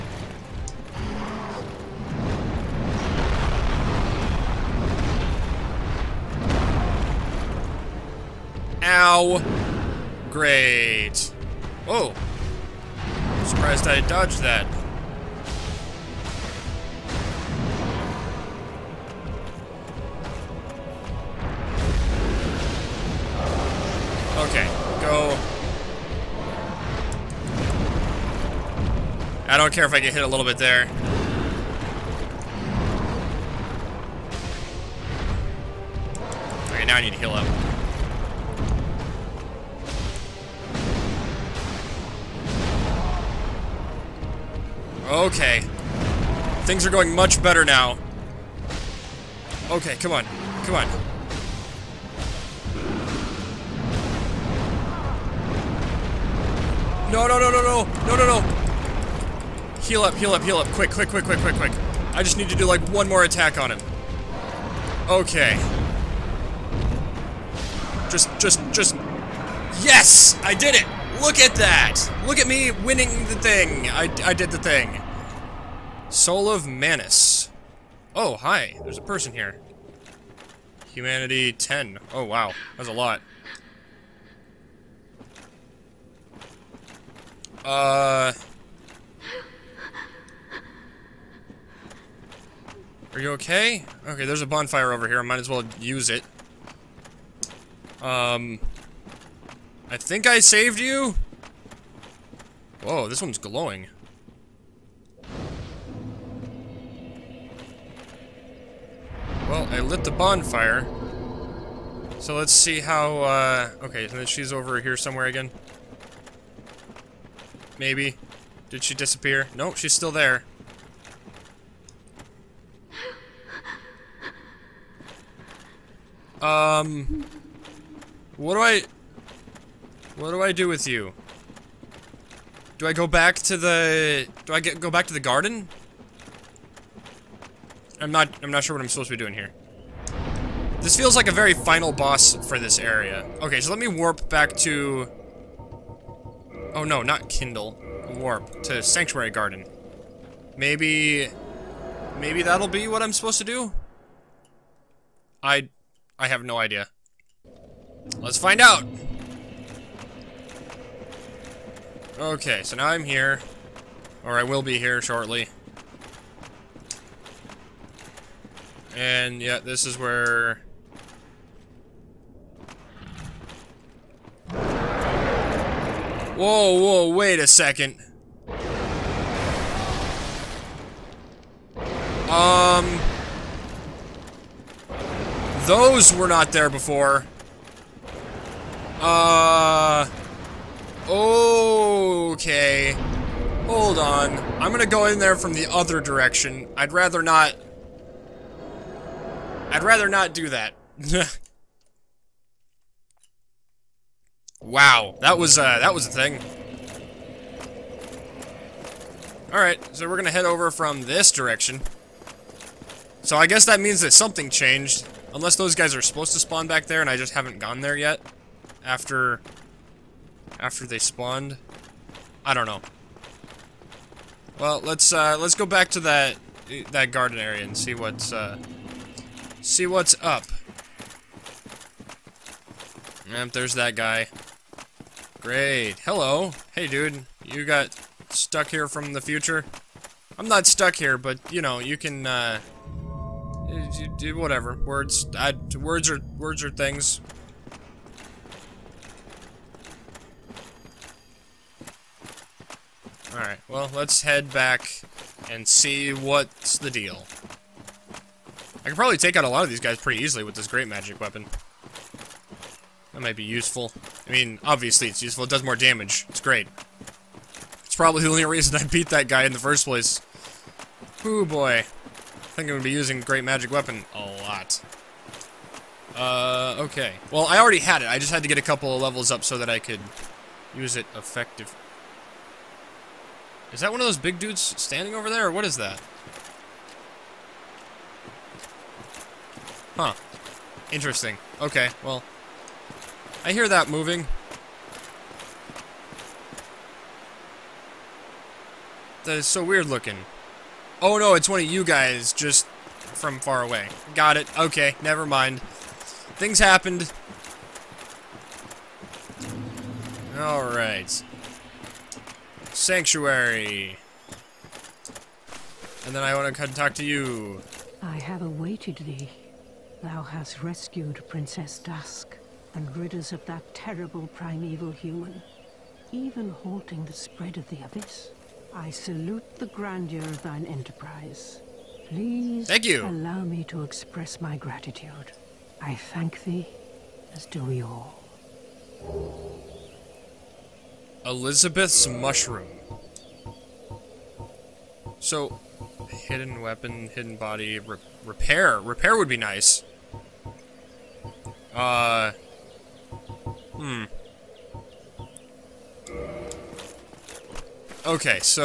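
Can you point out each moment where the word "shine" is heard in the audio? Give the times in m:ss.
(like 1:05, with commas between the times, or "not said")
not said.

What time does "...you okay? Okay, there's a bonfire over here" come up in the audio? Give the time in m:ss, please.
1:33.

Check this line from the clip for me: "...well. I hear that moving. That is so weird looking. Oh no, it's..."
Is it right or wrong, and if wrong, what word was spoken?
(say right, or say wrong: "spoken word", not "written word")
right.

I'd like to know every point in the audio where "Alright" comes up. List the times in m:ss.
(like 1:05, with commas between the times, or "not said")
3:29, 5:10.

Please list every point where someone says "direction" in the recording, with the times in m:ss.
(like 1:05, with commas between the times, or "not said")
3:15, 3:31.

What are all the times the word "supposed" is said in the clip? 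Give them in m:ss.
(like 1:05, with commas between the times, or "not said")
2:18, 2:33, 3:36.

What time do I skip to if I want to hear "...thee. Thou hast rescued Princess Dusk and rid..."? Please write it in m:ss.
5:18.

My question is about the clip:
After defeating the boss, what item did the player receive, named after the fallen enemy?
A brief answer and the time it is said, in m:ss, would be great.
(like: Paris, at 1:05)
Soul of Manus, at 1:16.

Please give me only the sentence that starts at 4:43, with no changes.
Is that one of those big dudes standing over there, or what is that?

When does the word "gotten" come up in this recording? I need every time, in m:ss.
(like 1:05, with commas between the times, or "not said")
not said.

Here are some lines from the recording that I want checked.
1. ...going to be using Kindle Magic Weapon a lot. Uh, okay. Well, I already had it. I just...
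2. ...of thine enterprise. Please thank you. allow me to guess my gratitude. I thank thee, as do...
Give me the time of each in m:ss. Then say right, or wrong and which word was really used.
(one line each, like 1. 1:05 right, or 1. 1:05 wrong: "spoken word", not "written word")
1. 4:32 wrong: "Great", not "Kindle"
2. 5:30 wrong: "express", not "guess".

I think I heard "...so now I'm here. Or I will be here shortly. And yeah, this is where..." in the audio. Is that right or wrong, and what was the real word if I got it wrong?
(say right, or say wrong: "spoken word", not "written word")
right.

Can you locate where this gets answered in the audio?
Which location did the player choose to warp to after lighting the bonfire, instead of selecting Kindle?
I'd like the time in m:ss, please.
2:28.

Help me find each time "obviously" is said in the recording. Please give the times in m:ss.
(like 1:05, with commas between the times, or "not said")
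4:24.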